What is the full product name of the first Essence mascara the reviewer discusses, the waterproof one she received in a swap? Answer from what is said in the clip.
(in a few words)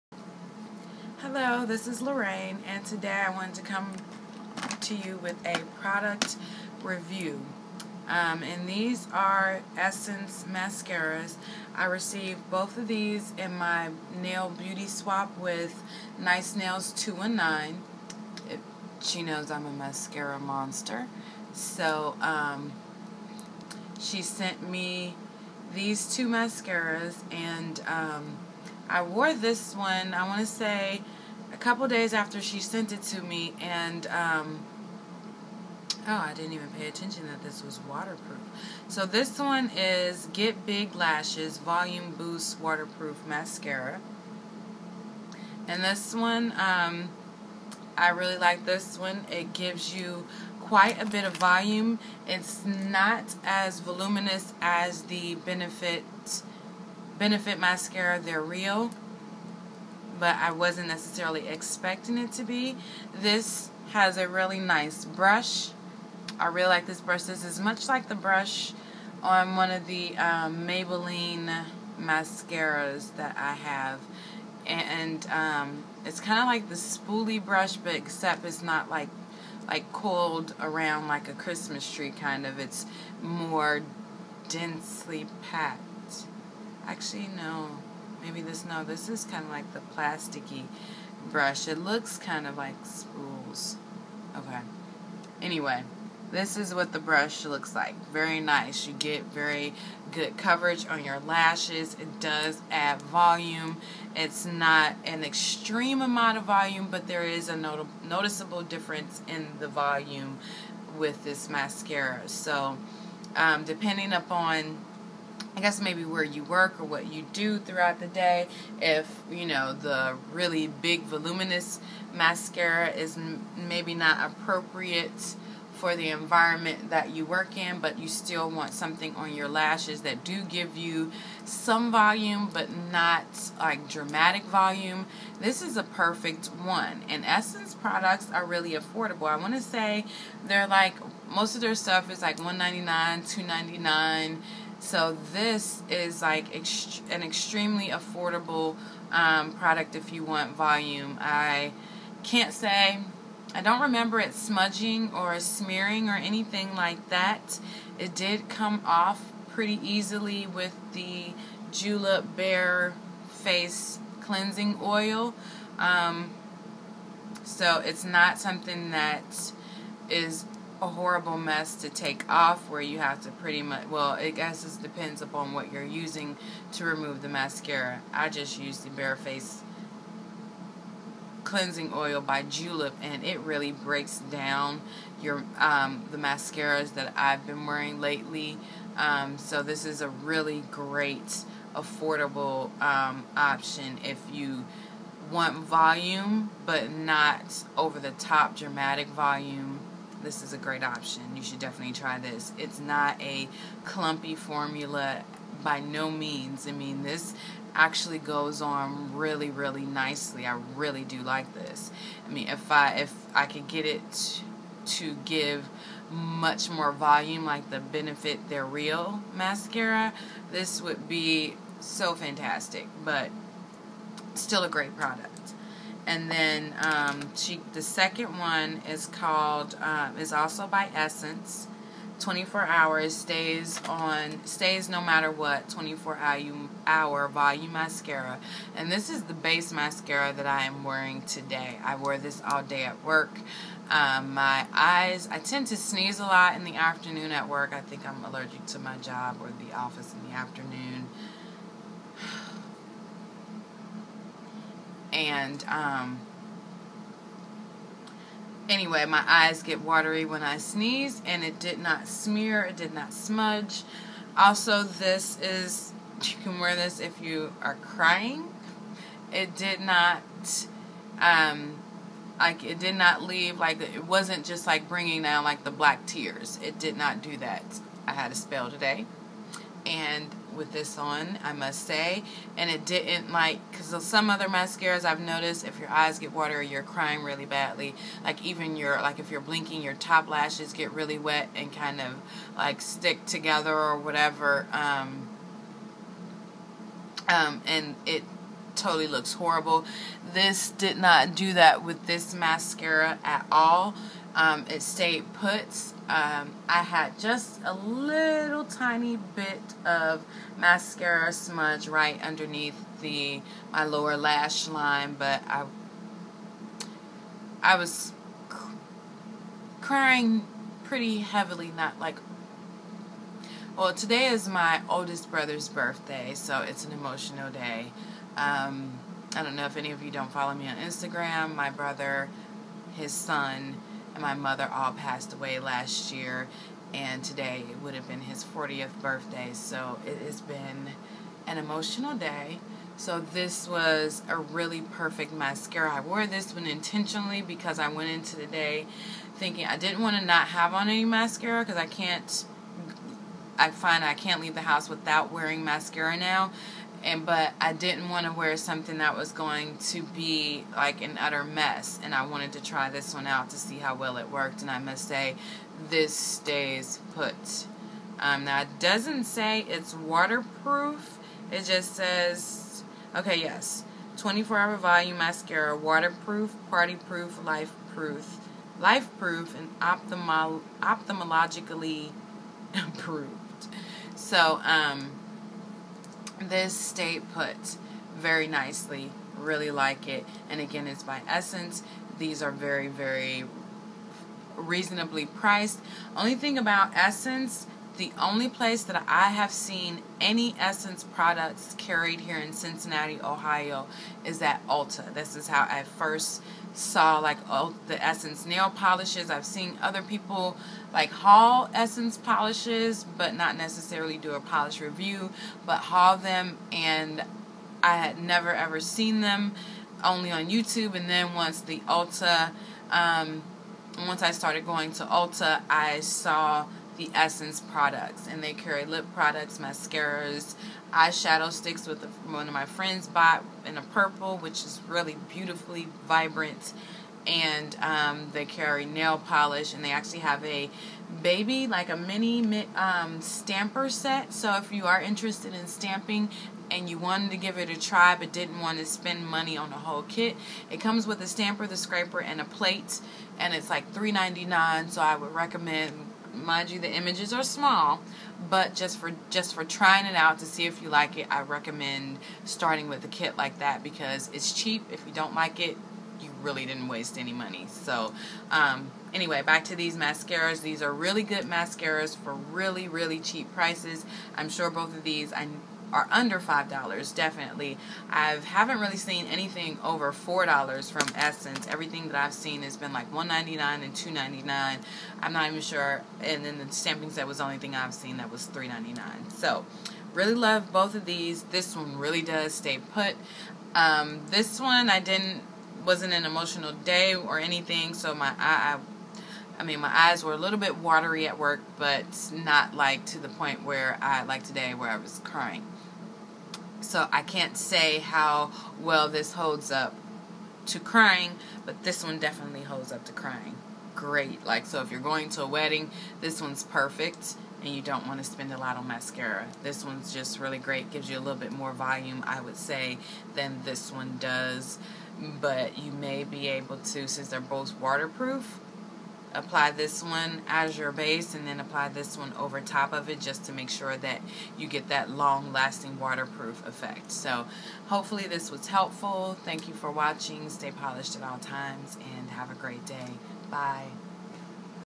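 Get Big Lashes Volume Boost.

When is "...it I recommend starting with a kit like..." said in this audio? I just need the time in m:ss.
7:41.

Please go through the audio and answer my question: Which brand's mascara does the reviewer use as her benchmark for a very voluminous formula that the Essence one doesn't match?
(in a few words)
Benefit They're Real.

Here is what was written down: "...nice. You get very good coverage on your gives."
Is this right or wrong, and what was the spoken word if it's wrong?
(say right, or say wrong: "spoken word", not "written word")
wrong: "lashes", not "gives".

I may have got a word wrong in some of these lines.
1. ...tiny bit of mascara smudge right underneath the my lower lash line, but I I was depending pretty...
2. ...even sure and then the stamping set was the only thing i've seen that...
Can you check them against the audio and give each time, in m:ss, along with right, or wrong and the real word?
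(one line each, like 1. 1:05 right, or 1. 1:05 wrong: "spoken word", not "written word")
1. 5:08 wrong: "crying", not "depending"
2. 8:05 right.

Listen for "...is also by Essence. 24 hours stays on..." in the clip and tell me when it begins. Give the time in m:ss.
3:50.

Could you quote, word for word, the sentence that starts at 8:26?
So I can't say how well this holds up to crying, but this one definitely holds up to crying.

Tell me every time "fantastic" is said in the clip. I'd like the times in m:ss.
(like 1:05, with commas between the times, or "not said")
3:42.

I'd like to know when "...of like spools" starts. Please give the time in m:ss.
1:32.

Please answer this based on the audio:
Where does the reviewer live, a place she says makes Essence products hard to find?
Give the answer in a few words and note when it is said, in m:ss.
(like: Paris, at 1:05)
Cincinnati, Ohio, at 6:42.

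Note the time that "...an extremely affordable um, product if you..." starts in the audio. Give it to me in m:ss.
2:27.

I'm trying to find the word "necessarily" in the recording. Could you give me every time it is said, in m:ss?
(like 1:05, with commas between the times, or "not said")
1:00, 6:53.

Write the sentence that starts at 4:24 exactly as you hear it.
Also, this is, you can wear this if you are crying.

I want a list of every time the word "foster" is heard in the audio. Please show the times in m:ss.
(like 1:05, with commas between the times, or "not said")
not said.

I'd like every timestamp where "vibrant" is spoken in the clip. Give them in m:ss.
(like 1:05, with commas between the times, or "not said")
7:16.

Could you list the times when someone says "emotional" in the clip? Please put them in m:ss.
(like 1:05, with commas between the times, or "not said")
5:26, 5:41, 8:16.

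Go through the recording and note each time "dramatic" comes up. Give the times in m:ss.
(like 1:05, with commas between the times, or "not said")
2:13, 3:18.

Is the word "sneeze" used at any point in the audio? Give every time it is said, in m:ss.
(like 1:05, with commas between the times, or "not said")
4:05, 4:20.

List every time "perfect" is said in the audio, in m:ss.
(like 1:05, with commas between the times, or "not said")
2:15, 5:44, 8:36.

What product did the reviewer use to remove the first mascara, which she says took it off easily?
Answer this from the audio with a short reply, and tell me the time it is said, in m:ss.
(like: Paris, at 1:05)
Julep Bare Face Cleansing Oil, at 2:41.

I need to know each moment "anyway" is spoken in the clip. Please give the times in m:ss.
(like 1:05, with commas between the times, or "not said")
1:35, 4:18, 7:49.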